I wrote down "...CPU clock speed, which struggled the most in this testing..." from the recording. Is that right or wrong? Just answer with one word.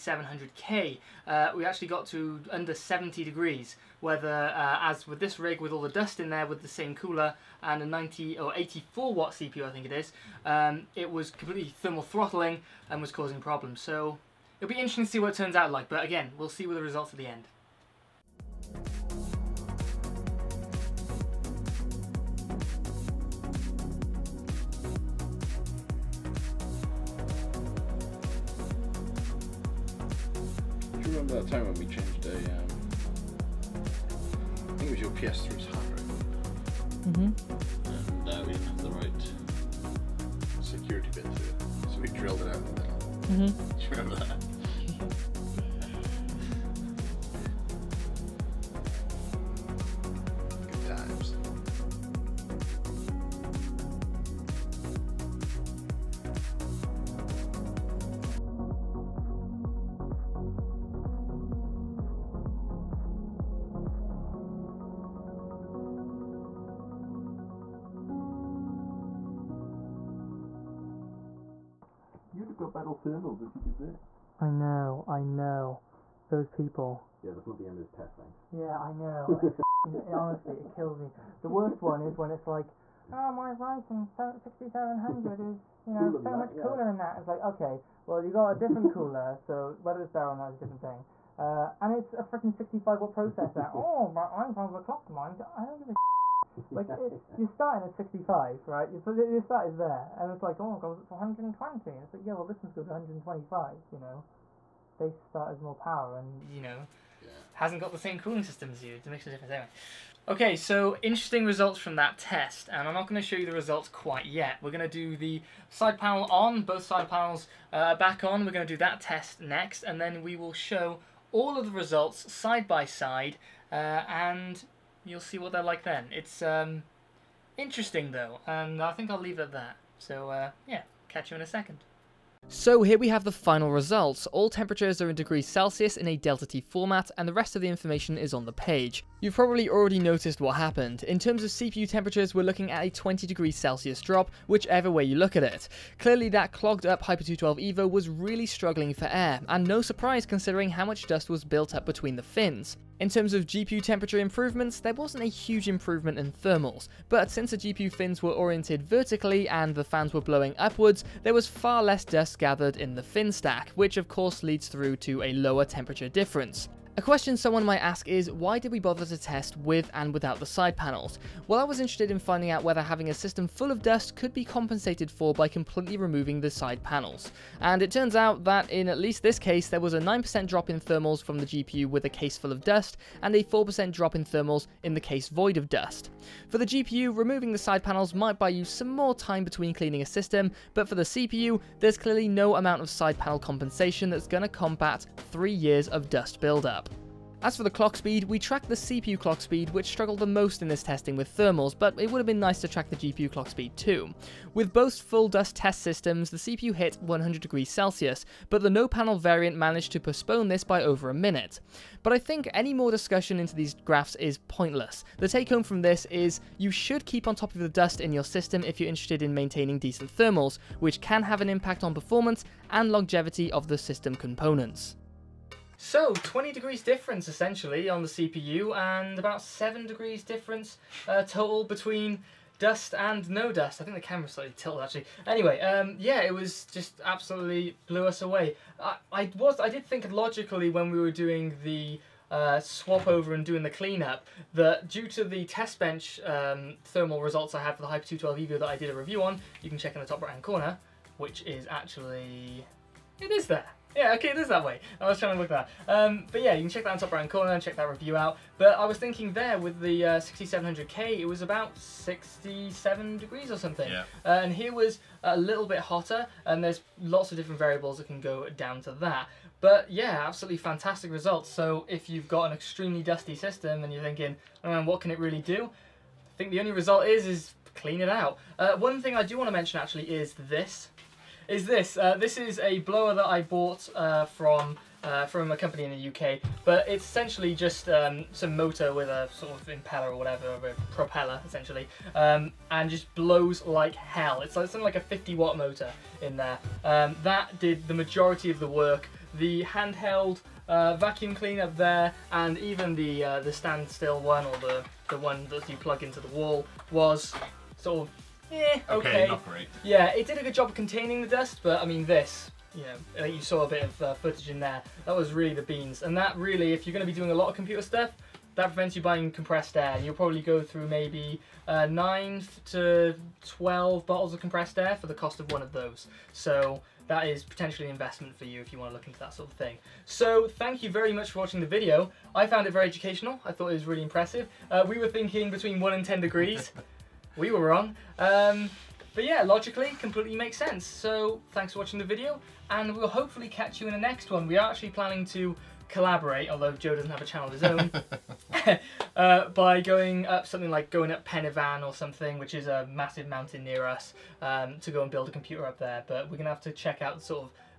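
right.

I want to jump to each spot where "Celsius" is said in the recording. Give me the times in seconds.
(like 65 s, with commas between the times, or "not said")
135 s, 143 s, 207 s.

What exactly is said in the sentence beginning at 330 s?
So thank you very much for watching the video.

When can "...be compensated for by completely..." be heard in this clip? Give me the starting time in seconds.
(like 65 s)
174 s.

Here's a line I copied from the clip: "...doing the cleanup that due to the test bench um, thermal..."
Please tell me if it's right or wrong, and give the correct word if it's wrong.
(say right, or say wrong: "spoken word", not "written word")
right.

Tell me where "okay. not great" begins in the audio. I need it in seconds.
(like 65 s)
309 s.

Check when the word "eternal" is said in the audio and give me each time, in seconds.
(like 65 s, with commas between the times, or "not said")
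not said.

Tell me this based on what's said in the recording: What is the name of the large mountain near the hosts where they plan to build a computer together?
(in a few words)
Pen y Fan.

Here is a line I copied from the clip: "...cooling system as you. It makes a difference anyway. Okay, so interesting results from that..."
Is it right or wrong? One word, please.
right.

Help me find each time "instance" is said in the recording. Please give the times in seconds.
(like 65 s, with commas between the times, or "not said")
not said.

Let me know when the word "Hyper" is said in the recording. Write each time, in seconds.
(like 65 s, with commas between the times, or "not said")
147 s, 247 s.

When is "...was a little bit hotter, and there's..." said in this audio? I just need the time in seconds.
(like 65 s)
264 s.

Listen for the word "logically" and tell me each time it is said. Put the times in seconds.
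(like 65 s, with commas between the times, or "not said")
240 s, 339 s.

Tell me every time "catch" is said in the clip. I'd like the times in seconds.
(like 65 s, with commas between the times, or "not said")
131 s, 343 s.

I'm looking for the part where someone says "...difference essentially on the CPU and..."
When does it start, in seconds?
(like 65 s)
226 s.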